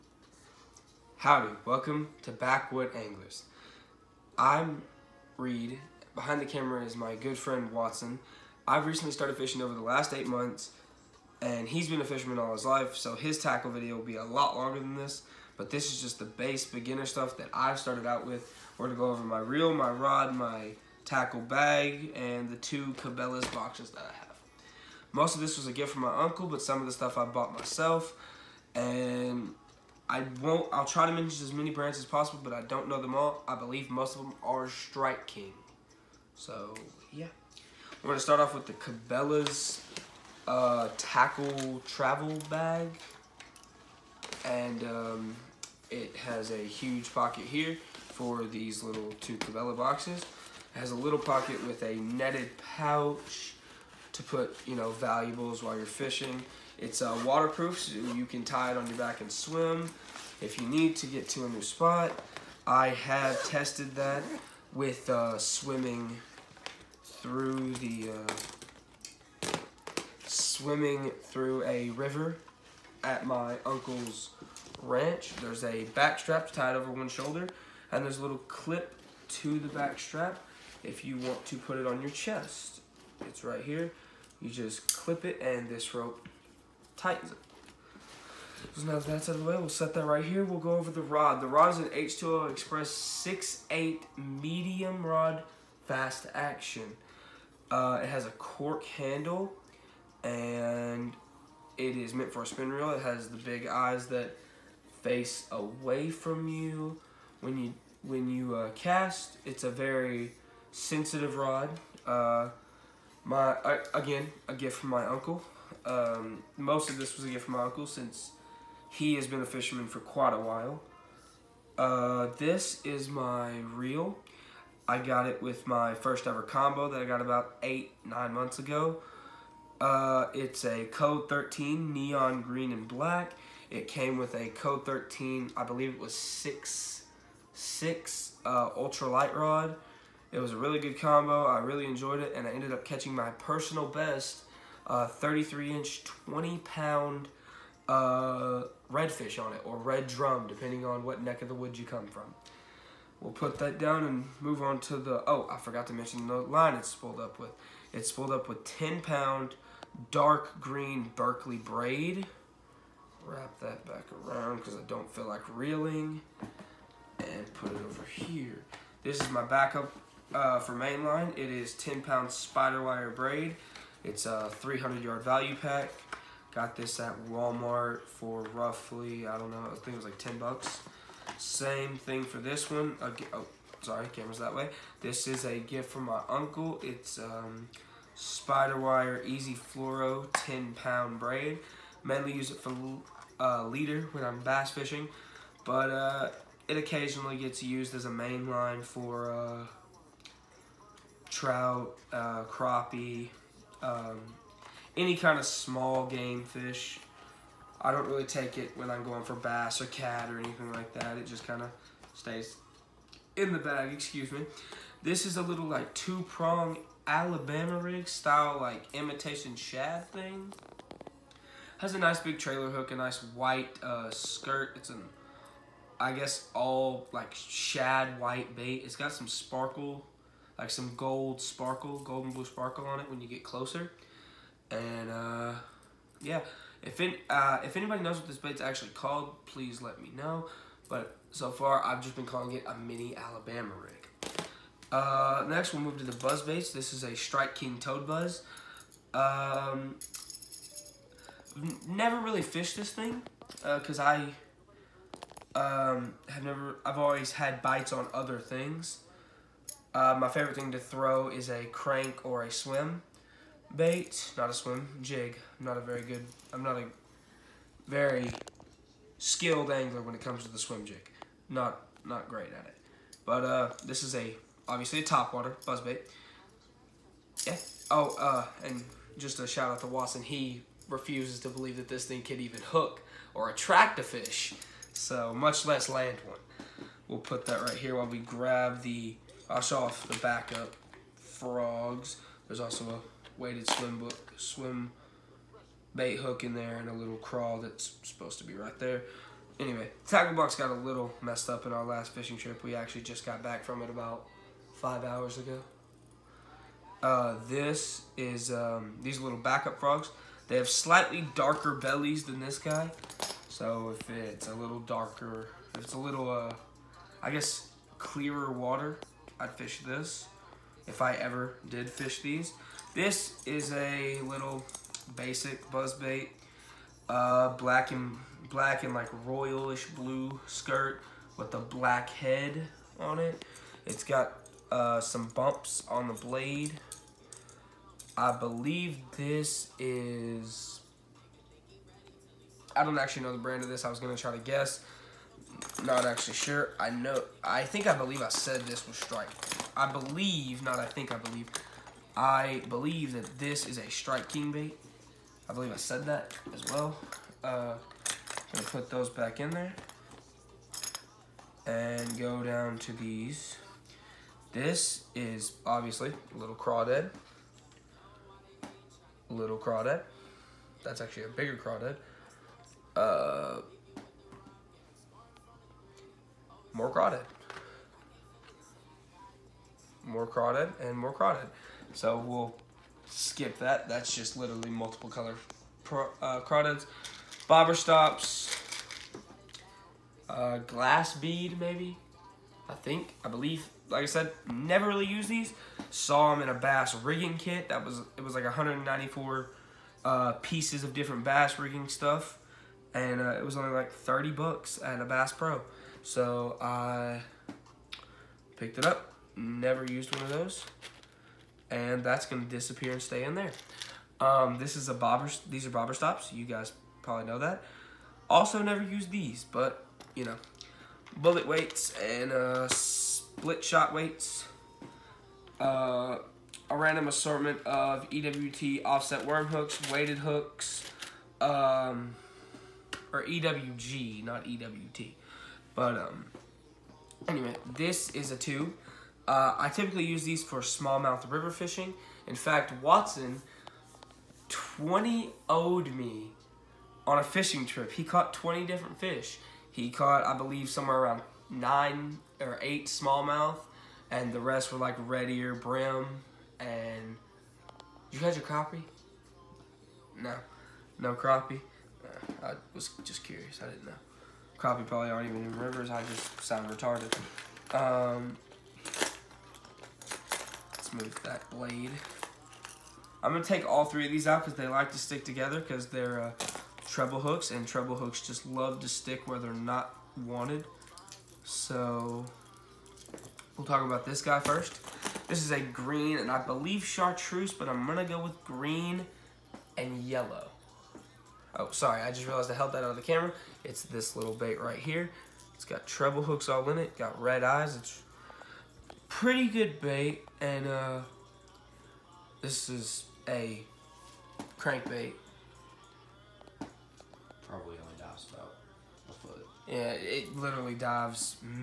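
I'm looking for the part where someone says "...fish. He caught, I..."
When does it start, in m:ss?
7:28.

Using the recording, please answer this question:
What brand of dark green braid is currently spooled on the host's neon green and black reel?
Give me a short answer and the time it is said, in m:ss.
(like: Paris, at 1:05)
Berkley, at 2:41.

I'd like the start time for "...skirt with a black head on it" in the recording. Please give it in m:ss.
5:30.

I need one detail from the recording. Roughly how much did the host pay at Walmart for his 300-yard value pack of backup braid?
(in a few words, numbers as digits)
$10.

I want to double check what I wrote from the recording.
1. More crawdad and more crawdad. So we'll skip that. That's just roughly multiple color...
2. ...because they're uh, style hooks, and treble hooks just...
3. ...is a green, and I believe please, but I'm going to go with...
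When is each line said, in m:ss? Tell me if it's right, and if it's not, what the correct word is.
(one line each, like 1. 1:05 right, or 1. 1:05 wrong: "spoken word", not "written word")
1. 6:20 wrong: "literally", not "roughly"
2. 7:55 wrong: "treble", not "style"
3. 8:05 wrong: "chartreuse", not "please".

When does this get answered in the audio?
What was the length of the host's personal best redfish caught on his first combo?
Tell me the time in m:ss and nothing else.
2:25.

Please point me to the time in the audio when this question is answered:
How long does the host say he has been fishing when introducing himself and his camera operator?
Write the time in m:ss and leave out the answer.
0:10.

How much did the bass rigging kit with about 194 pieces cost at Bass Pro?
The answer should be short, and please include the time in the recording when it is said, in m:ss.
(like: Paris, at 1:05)
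$30, at 6:43.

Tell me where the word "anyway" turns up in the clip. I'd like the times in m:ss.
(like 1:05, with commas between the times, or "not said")
4:59, 7:17.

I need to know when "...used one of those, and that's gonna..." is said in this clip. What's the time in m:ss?
6:49.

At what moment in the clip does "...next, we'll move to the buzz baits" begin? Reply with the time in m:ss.
4:05.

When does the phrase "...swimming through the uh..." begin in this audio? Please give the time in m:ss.
1:05.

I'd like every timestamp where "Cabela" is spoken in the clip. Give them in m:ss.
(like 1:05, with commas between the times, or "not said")
0:22, 0:38, 0:49.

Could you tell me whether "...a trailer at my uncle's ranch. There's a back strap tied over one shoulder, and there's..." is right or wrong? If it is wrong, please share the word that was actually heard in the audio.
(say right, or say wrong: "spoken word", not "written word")
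wrong: "river", not "trailer".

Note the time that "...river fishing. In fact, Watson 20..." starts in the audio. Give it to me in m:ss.
7:21.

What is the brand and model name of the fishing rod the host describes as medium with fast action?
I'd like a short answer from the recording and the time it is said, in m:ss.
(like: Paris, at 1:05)
H2O Express, at 1:31.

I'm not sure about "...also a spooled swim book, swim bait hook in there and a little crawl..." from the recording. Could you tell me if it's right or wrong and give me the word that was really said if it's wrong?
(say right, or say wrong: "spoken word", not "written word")
wrong: "weighted", not "spooled".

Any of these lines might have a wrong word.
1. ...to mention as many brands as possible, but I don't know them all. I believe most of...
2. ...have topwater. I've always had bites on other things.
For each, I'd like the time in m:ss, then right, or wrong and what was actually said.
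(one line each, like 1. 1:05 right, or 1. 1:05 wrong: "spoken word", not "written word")
1. 0:31 right
2. 4:16 wrong: "never", not "topwater".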